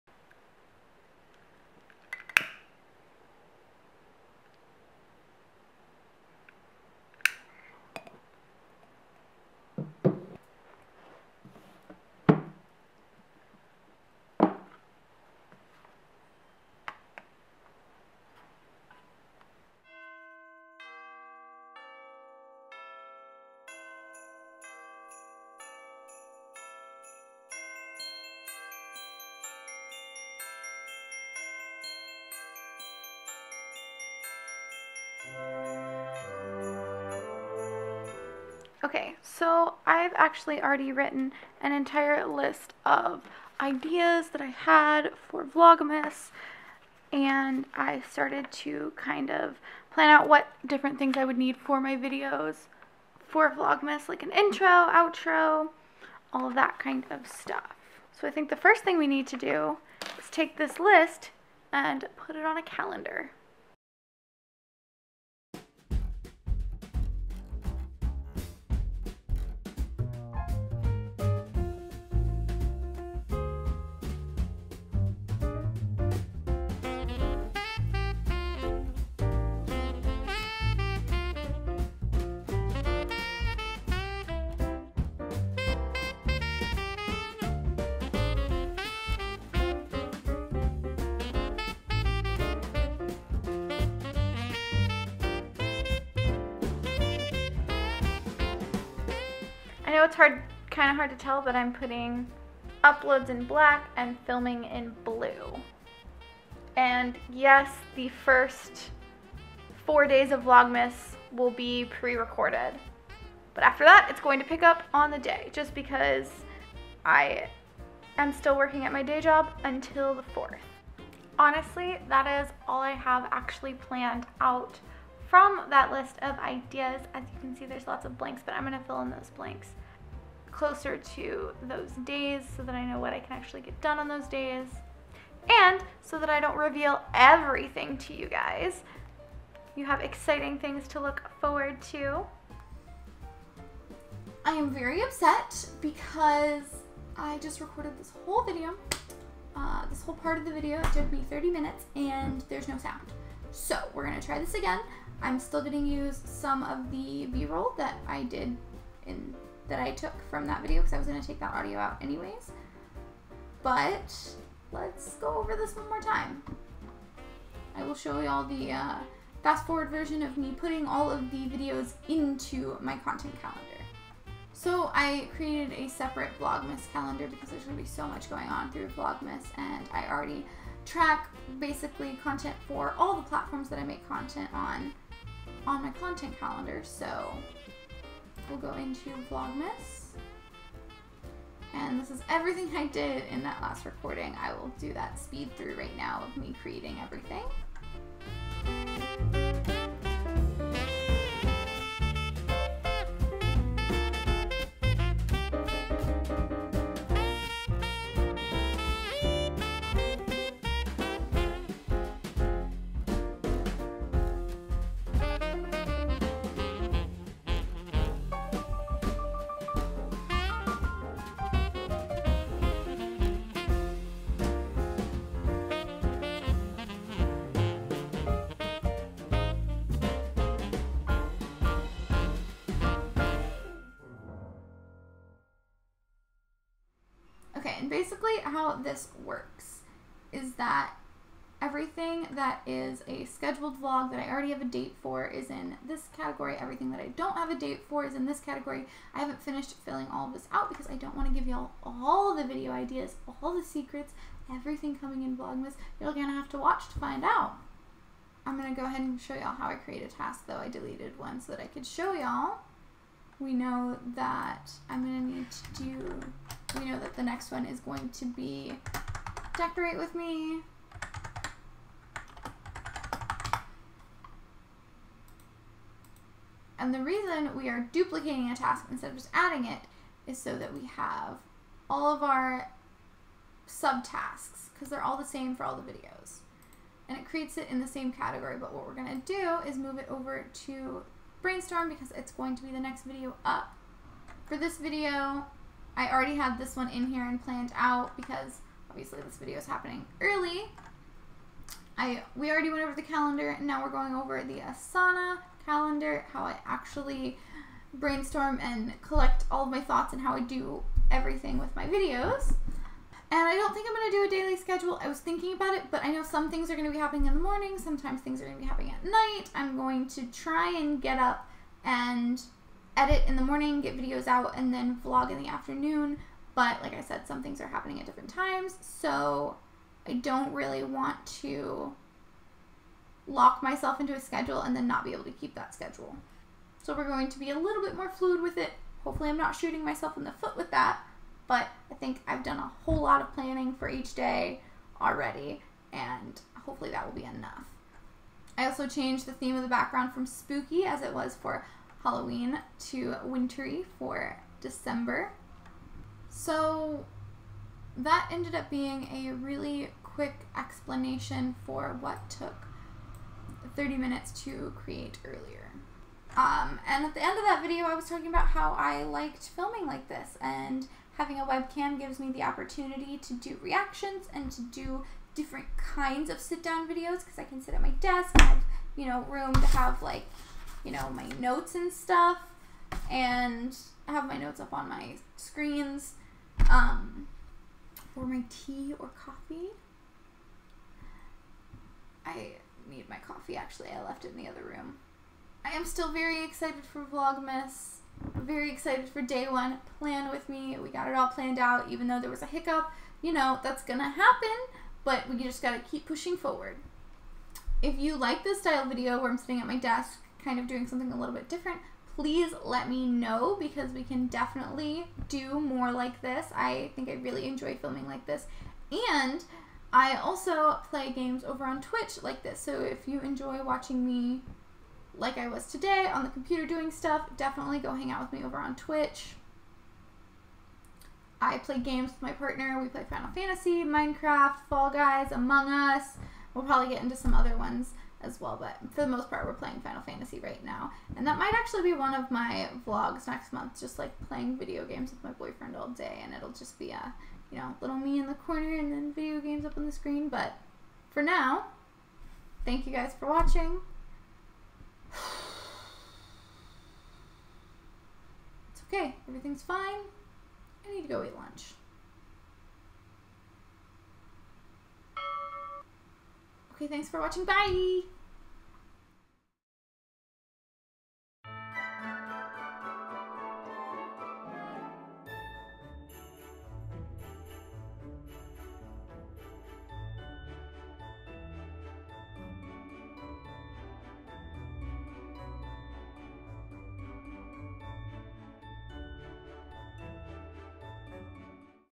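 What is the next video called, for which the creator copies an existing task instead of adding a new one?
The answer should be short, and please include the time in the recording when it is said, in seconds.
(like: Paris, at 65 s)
decorate with me, at 269 s.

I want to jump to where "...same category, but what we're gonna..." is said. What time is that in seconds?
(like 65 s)
287 s.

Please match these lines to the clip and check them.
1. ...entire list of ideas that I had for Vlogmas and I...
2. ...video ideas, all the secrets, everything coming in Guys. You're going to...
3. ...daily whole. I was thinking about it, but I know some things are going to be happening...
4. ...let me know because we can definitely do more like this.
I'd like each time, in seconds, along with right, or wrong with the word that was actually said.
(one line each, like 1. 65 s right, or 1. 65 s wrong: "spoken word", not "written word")
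1. 41 s right
2. 252 s wrong: "Vlogmas", not "Guys"
3. 314 s wrong: "schedule", not "whole"
4. 412 s right.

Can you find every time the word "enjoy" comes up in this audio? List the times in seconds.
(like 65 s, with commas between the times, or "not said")
417 s, 423 s.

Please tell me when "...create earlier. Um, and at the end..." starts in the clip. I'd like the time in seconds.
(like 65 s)
364 s.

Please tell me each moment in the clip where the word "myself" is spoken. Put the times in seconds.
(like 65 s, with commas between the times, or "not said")
333 s, 339 s.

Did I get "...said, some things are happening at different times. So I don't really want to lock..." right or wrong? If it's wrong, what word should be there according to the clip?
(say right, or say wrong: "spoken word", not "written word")
right.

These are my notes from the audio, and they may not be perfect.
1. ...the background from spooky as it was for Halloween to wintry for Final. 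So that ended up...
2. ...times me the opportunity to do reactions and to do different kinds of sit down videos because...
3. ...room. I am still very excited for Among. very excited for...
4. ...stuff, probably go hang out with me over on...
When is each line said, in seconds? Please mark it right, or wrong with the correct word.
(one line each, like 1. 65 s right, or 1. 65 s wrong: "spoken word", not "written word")
1. 349 s wrong: "December", not "Final"
2. 371 s wrong: "gives", not "times"
3. 394 s wrong: "Vlogmas", not "Among"
4. 426 s wrong: "definitely", not "probably".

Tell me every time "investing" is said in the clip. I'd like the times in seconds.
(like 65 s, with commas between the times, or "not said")
not said.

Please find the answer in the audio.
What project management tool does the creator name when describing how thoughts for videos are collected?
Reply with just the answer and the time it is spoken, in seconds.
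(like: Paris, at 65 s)
Asana, at 304 s.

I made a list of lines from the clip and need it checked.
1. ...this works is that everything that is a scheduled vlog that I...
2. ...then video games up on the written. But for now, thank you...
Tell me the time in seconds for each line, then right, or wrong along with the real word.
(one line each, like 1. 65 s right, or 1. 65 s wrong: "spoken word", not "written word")
1. 238 s right
2. 448 s wrong: "screen", not "written".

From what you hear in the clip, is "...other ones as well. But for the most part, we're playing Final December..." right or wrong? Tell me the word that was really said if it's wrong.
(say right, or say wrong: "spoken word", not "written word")
wrong: "Fantasy", not "December".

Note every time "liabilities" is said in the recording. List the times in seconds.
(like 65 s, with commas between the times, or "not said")
not said.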